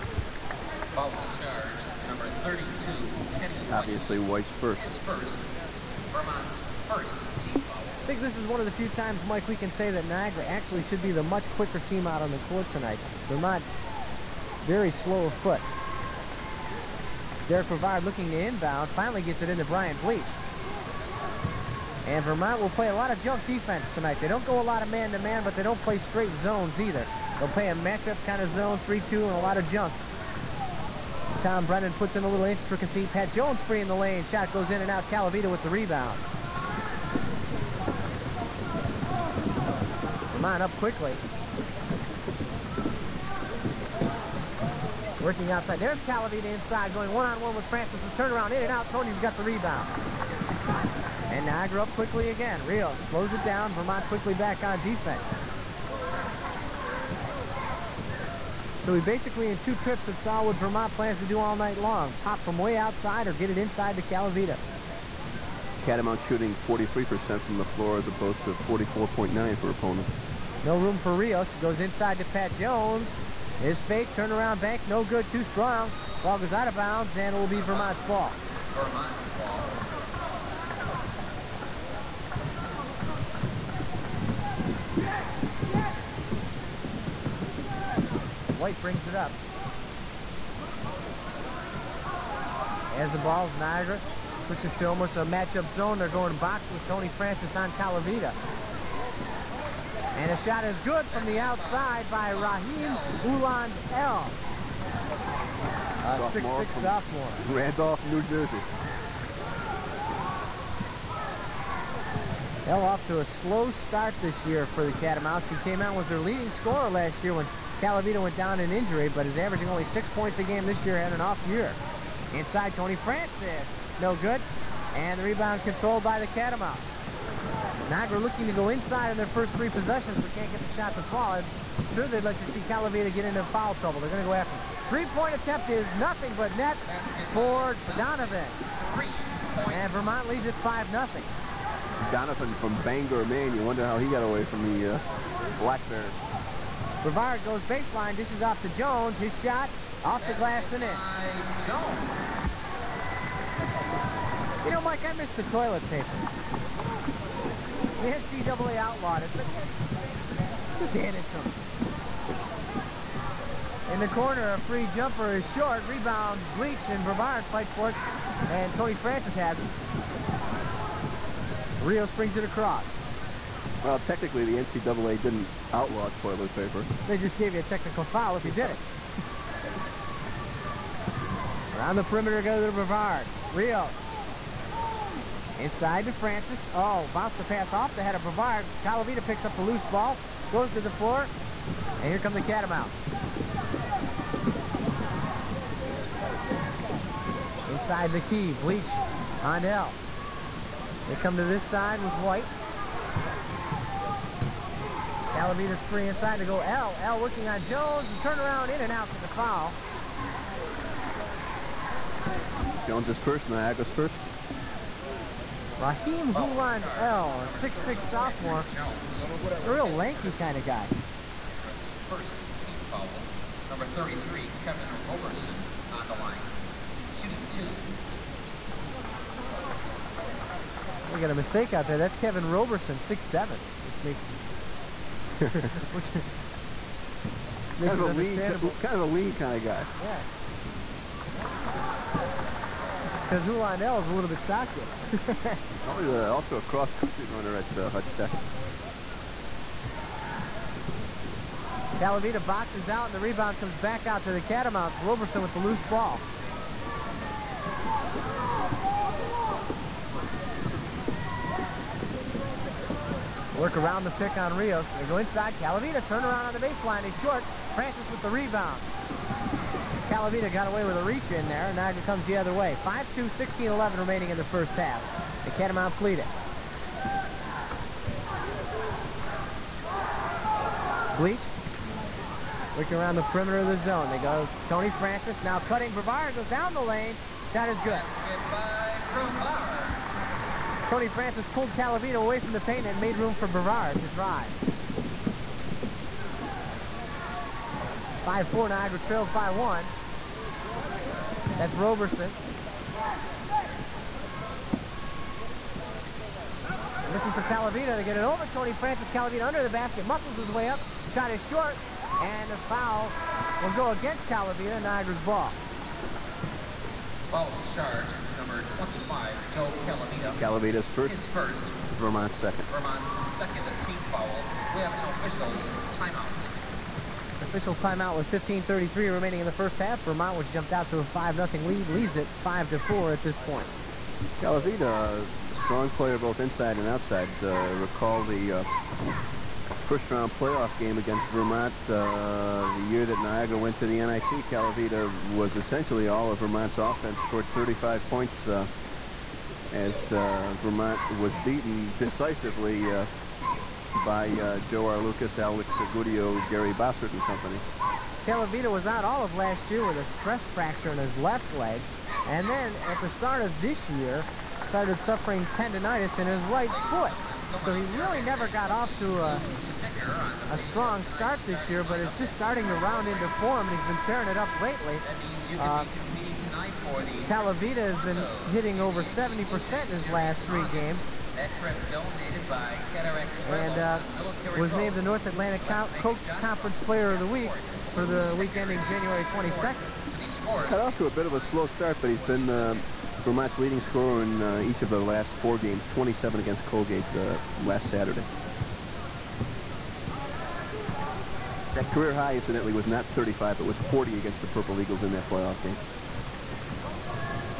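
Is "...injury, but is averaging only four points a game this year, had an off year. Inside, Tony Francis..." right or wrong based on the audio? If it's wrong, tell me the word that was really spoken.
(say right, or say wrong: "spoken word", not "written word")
wrong: "six", not "four".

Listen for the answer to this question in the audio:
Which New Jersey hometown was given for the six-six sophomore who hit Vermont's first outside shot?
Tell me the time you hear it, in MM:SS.
01:47.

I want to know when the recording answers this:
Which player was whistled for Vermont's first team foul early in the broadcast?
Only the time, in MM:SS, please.
00:03.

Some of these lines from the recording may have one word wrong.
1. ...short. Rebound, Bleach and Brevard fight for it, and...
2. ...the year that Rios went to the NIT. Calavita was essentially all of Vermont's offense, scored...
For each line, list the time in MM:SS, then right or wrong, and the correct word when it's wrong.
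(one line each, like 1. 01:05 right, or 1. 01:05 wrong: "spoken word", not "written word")
1. 02:45 right
2. 05:42 wrong: "Niagara", not "Rios".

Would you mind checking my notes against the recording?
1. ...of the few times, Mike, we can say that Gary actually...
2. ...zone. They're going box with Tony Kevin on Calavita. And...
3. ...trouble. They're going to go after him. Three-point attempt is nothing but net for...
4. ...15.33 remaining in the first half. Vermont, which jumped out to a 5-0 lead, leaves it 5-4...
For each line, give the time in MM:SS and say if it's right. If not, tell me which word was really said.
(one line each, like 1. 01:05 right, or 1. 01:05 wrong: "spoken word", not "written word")
1. 00:08 wrong: "Niagara", not "Gary"
2. 01:35 wrong: "Francis", not "Kevin"
3. 02:13 right
4. 05:28 right.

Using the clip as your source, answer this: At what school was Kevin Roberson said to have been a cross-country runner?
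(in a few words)
Hutch Tech.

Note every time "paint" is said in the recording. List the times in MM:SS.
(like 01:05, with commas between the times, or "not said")
04:52.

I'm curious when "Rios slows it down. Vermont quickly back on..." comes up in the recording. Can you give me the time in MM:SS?
00:52.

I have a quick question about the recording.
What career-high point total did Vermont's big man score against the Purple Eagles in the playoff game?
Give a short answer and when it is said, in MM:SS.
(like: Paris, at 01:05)
40, at 06:43.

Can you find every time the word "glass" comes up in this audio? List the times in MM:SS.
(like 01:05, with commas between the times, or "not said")
02:30.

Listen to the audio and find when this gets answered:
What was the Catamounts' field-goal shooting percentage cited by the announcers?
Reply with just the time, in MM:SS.
01:06.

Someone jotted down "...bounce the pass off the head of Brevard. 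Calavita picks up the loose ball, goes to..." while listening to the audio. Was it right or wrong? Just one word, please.
right.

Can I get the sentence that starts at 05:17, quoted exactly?
Foul charge charged to number 25, Joe Calavita.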